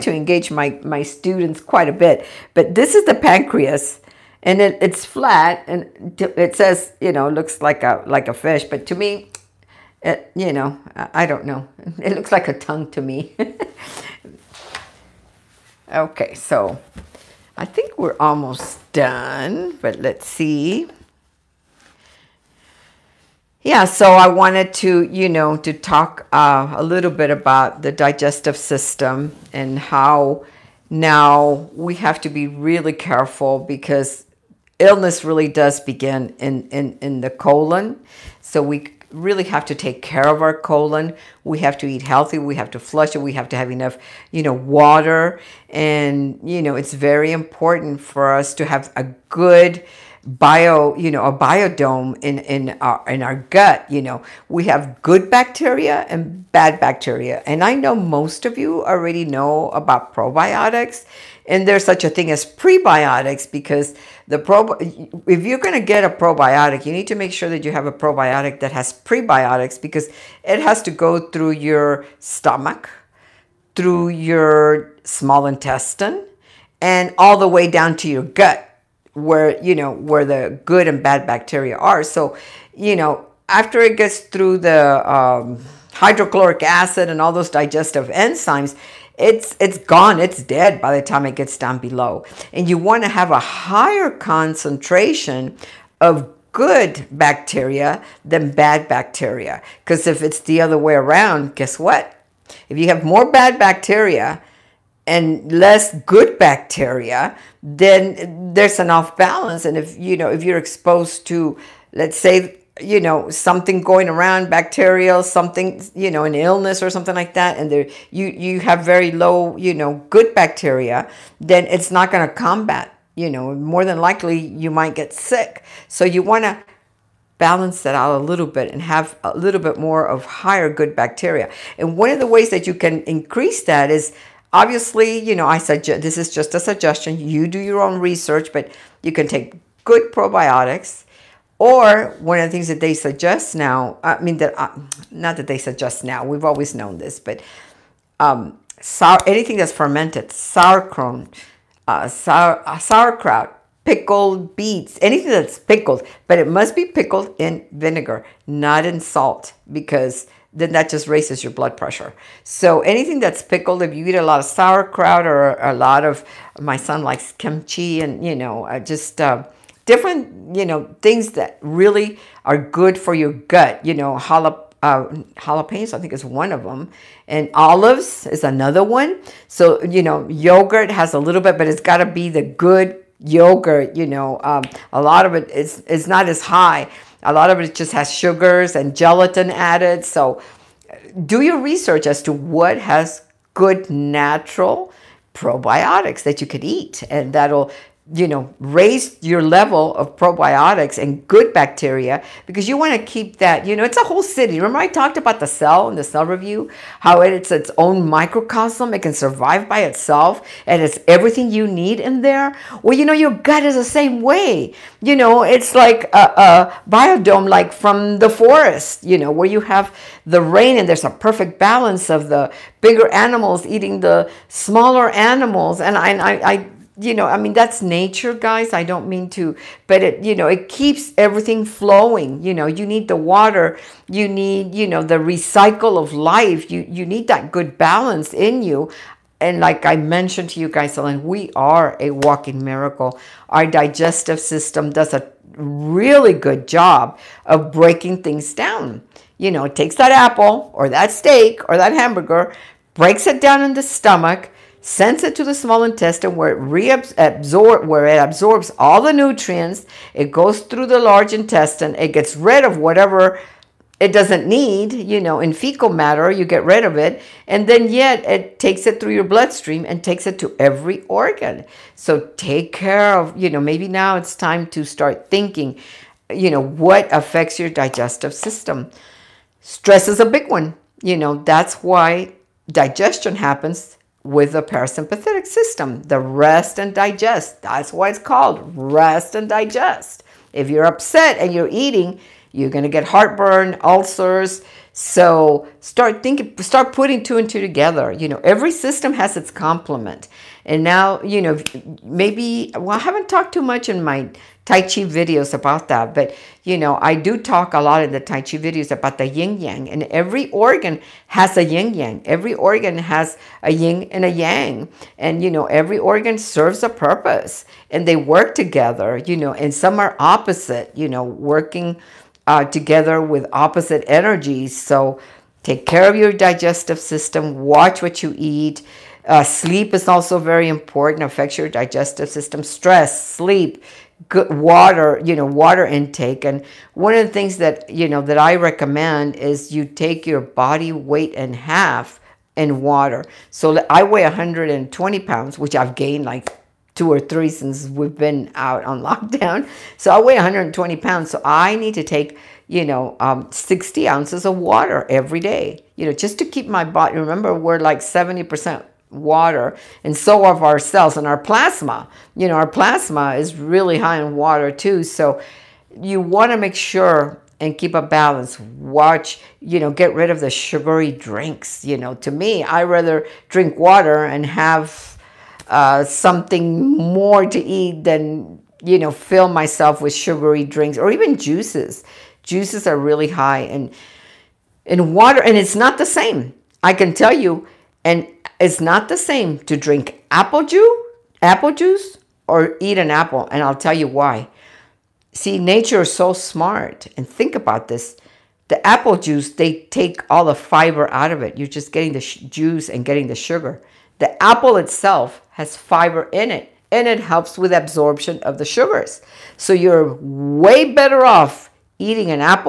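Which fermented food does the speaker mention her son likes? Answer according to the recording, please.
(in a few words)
Kimchi.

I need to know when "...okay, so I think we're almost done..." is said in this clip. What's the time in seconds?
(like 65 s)
15 s.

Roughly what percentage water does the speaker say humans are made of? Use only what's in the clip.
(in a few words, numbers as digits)
70%.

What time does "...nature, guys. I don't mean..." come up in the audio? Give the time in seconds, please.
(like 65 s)
227 s.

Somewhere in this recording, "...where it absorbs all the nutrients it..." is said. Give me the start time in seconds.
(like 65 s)
257 s.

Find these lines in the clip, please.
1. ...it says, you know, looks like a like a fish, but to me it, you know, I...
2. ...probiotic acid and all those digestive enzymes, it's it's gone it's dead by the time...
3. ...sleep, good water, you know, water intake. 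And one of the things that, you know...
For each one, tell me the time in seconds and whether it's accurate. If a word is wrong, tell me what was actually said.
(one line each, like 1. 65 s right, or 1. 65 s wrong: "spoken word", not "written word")
1. 6 s right
2. 85 s wrong: "hydrochloric", not "probiotic"
3. 333 s right.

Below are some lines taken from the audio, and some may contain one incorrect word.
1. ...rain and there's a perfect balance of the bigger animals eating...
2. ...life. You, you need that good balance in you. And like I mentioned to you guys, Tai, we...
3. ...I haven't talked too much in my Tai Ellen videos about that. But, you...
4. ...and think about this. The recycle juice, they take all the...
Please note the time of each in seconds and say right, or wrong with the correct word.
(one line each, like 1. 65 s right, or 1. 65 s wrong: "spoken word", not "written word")
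1. 220 s right
2. 236 s wrong: "Ellen", not "Tai"
3. 302 s wrong: "Chi", not "Ellen"
4. 397 s wrong: "apple", not "recycle".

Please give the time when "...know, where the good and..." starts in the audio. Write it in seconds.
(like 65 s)
79 s.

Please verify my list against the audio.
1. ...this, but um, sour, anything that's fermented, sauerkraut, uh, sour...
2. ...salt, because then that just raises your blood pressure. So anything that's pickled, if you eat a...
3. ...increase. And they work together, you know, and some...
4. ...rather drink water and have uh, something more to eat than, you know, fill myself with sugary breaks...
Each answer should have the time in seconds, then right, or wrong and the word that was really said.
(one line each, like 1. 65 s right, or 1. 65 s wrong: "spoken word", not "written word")
1. 146 s right
2. 159 s right
3. 316 s wrong: "purpose", not "increase"
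4. 372 s wrong: "drinks", not "breaks".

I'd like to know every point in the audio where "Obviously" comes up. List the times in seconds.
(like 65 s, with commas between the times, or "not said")
134 s.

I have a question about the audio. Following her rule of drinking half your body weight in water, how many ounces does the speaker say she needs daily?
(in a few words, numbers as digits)
60 ounces.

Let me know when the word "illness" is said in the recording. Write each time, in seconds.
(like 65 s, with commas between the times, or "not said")
34 s, 116 s.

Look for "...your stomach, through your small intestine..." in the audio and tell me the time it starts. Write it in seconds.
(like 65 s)
71 s.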